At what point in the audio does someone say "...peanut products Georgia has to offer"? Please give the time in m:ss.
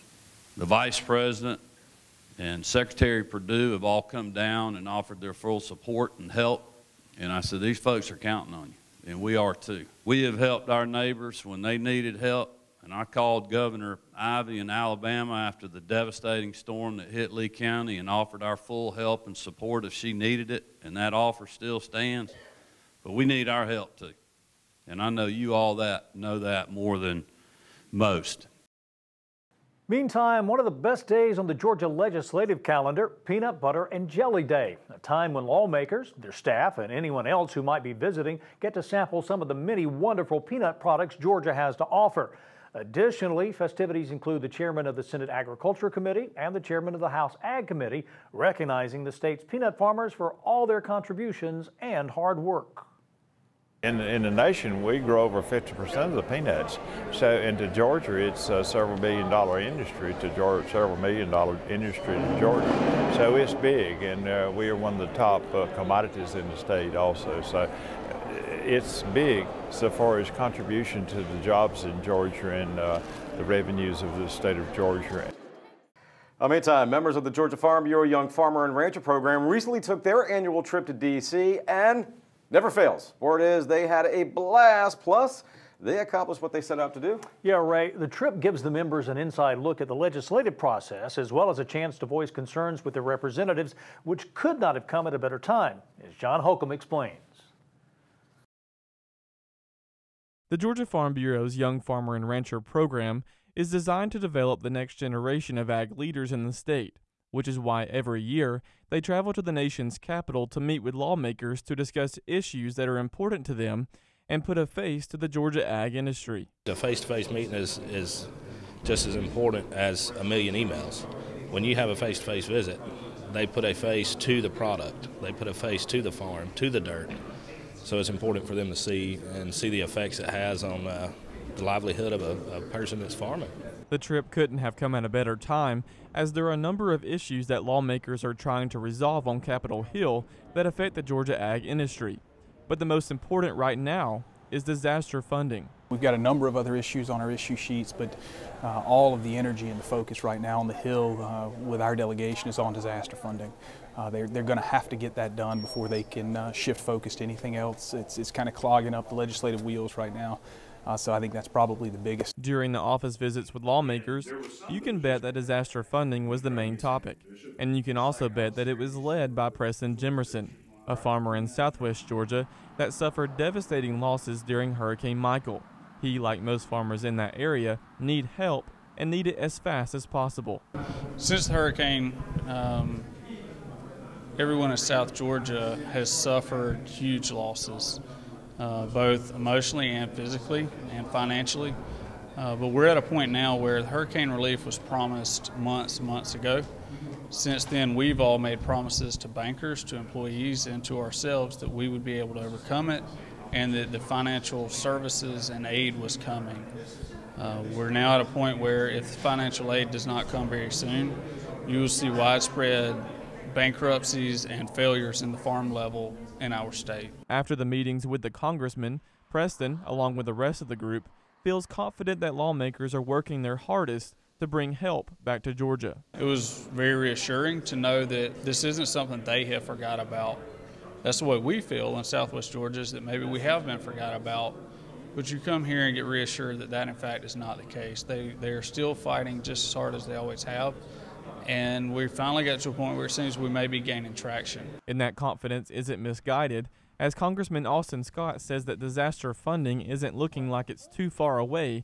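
0:40.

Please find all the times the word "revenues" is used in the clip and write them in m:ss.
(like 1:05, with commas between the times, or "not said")
1:13.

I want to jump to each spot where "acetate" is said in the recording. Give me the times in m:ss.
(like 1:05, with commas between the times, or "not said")
not said.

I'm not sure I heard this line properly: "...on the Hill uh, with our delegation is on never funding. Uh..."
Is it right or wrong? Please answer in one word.
wrong.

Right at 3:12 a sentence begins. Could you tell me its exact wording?
Uh, but we're at a point now where hurricane relief was promised months months ago.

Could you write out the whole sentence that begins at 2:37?
It's, it's kind of clogging up the legislative wheels right now.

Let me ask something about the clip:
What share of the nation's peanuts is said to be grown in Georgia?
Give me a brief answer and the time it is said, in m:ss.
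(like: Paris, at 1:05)
over 50%, at 0:55.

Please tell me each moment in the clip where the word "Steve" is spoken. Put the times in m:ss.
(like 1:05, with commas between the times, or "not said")
not said.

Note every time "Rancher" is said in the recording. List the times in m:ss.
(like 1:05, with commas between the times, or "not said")
1:18, 1:42.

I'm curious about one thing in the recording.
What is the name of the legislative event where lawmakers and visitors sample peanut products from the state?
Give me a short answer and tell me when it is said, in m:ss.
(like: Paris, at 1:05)
Peanut Butter and Jelly Day, at 0:33.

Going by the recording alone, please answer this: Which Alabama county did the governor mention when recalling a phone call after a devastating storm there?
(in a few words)
Lee County.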